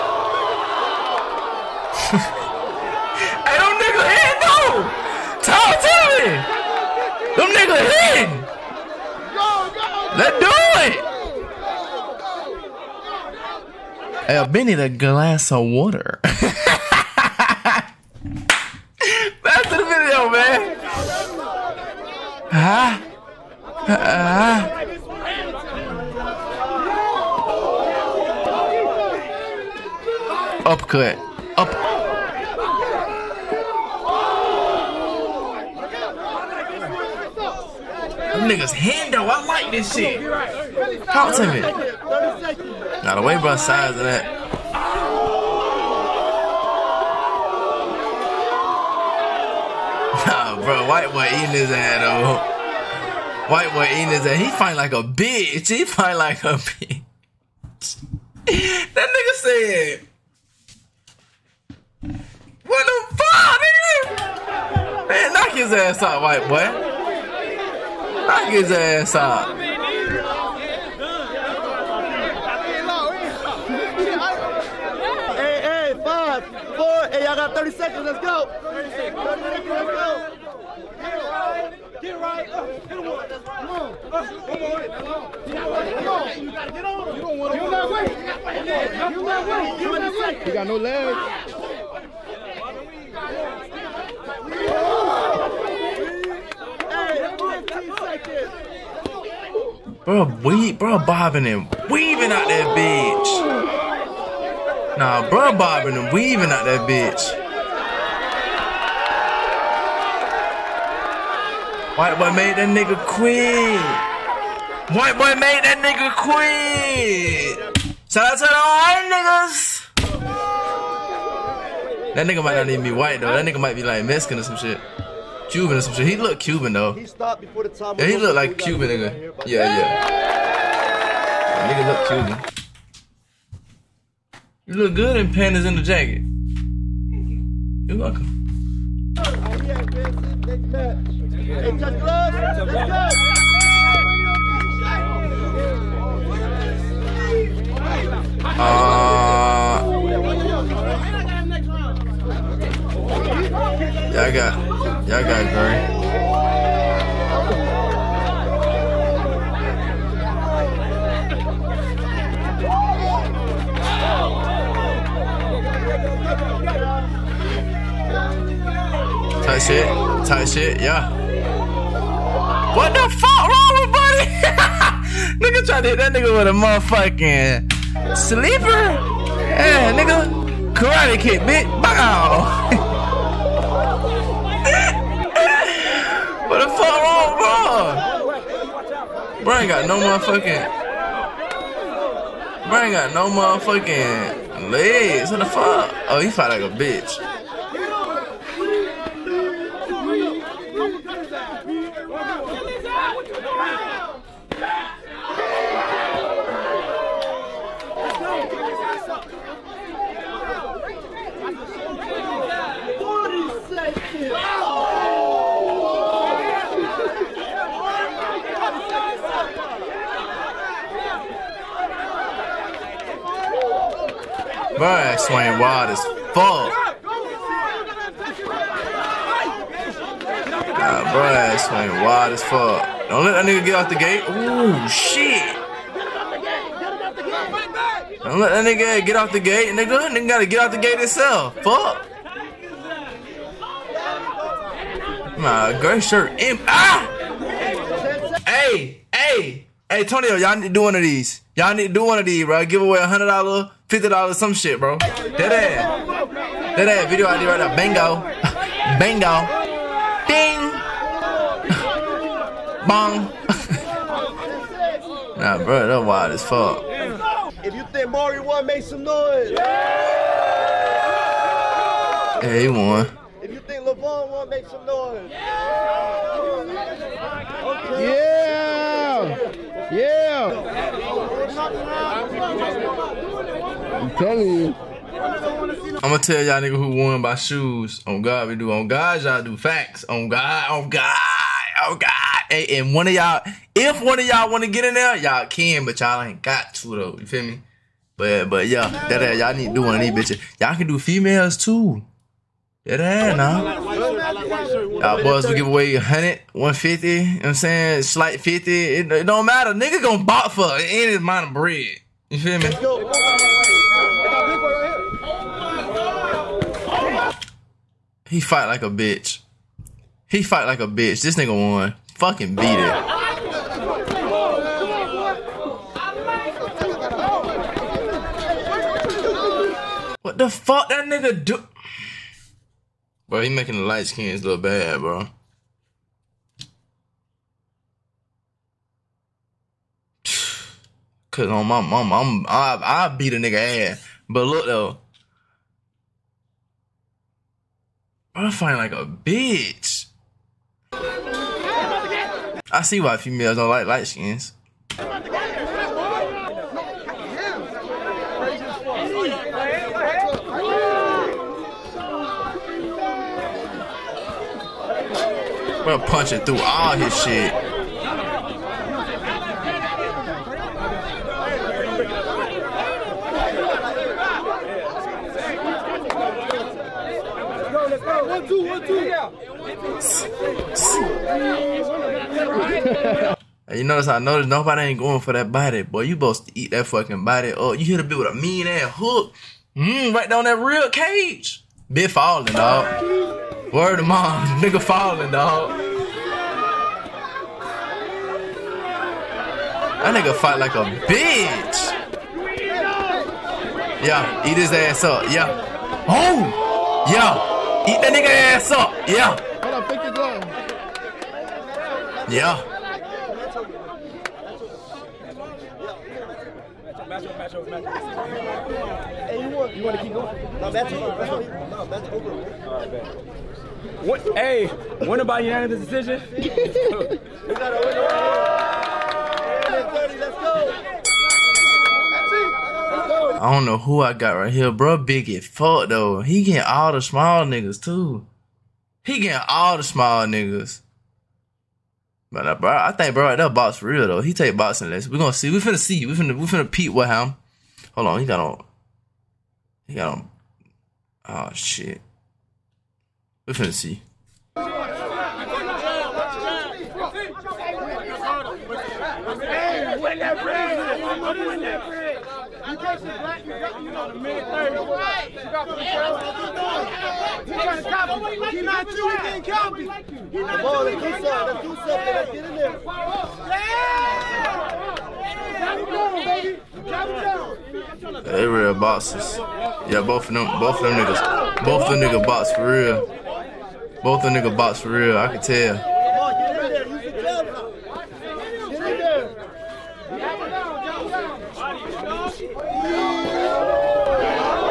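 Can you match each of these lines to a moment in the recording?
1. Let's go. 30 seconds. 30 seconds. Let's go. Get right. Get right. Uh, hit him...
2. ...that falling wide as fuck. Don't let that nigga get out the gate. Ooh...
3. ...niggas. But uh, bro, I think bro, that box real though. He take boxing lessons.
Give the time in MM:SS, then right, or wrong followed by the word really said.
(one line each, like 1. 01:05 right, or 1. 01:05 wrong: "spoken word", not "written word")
1. 01:18 right
2. 03:51 wrong: "swing", not "falling"
3. 07:20 right.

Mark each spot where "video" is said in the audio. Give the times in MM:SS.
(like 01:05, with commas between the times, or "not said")
00:19, 04:17.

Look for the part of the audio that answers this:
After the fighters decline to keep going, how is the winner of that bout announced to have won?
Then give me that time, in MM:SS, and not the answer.
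07:05.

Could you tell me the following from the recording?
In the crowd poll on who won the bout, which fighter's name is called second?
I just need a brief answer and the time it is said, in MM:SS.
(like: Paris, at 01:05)
LeVon, at 04:33.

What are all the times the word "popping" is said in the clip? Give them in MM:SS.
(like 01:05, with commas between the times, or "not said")
not said.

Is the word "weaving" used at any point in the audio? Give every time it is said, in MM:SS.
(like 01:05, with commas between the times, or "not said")
01:41, 01:46.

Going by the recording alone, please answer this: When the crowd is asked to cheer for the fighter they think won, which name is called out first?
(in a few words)
Mario.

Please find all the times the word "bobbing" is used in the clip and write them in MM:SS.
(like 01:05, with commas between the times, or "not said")
01:40, 01:45.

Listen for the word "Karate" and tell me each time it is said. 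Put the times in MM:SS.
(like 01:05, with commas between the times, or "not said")
03:00.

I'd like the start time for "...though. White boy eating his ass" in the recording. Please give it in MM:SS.
00:52.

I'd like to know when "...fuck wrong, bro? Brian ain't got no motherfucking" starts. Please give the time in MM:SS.
03:06.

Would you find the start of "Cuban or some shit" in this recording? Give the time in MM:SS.
02:05.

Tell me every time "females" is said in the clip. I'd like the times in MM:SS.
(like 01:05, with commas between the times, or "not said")
05:00, 05:53.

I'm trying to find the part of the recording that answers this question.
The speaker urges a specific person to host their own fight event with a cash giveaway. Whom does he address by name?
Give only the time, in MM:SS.
04:10.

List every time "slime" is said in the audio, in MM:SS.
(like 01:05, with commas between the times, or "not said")
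not said.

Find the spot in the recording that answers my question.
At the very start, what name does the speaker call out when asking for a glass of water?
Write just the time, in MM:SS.
00:14.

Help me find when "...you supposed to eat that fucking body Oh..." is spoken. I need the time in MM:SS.
06:26.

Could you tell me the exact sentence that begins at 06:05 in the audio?
We're punching through all his shit.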